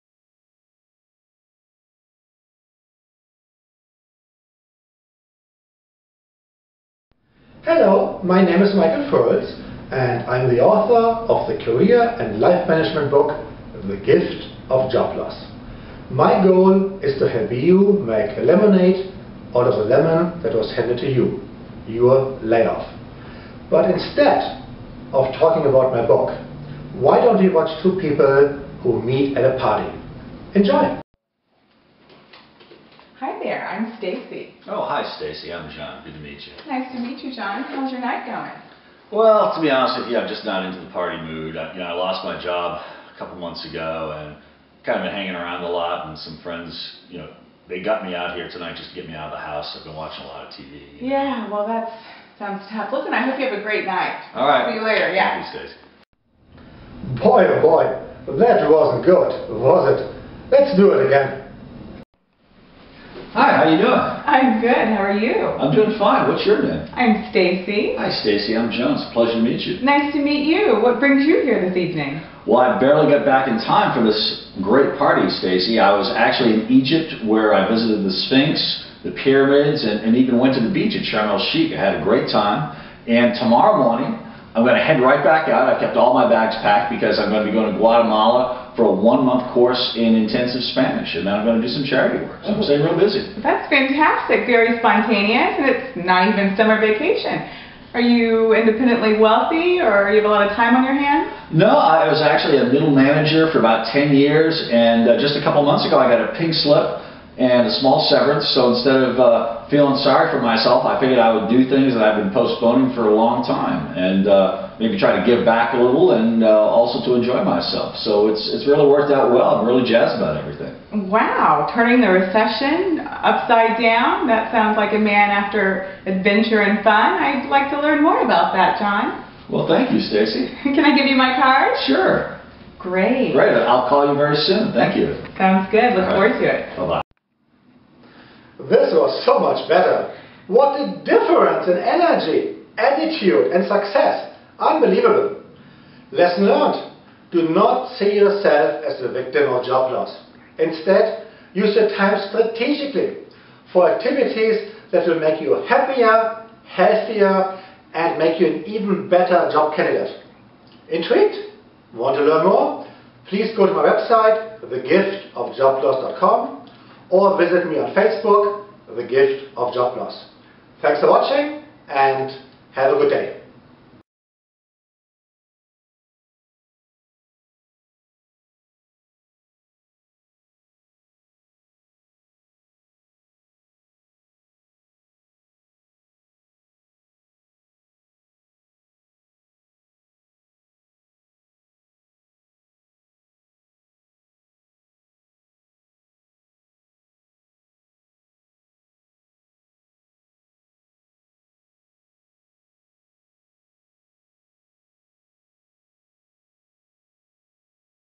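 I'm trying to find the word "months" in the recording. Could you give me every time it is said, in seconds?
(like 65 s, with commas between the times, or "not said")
43 s, 88 s, 105 s.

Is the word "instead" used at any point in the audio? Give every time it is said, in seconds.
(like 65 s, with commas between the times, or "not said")
23 s, 108 s, 150 s.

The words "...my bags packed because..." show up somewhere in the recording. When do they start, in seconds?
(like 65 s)
86 s.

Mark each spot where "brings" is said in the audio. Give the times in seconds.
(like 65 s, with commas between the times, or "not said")
70 s.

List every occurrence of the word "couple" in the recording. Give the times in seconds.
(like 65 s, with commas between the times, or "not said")
43 s, 105 s.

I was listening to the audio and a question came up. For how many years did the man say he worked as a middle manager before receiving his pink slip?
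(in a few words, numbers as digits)
10.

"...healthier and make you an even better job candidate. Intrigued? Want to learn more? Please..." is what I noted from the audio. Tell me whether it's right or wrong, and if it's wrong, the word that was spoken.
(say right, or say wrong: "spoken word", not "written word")
right.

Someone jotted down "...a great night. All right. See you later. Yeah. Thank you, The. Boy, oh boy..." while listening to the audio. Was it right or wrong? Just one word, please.
wrong.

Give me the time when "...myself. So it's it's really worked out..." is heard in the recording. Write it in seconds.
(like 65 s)
117 s.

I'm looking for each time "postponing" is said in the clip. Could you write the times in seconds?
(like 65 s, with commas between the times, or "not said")
112 s.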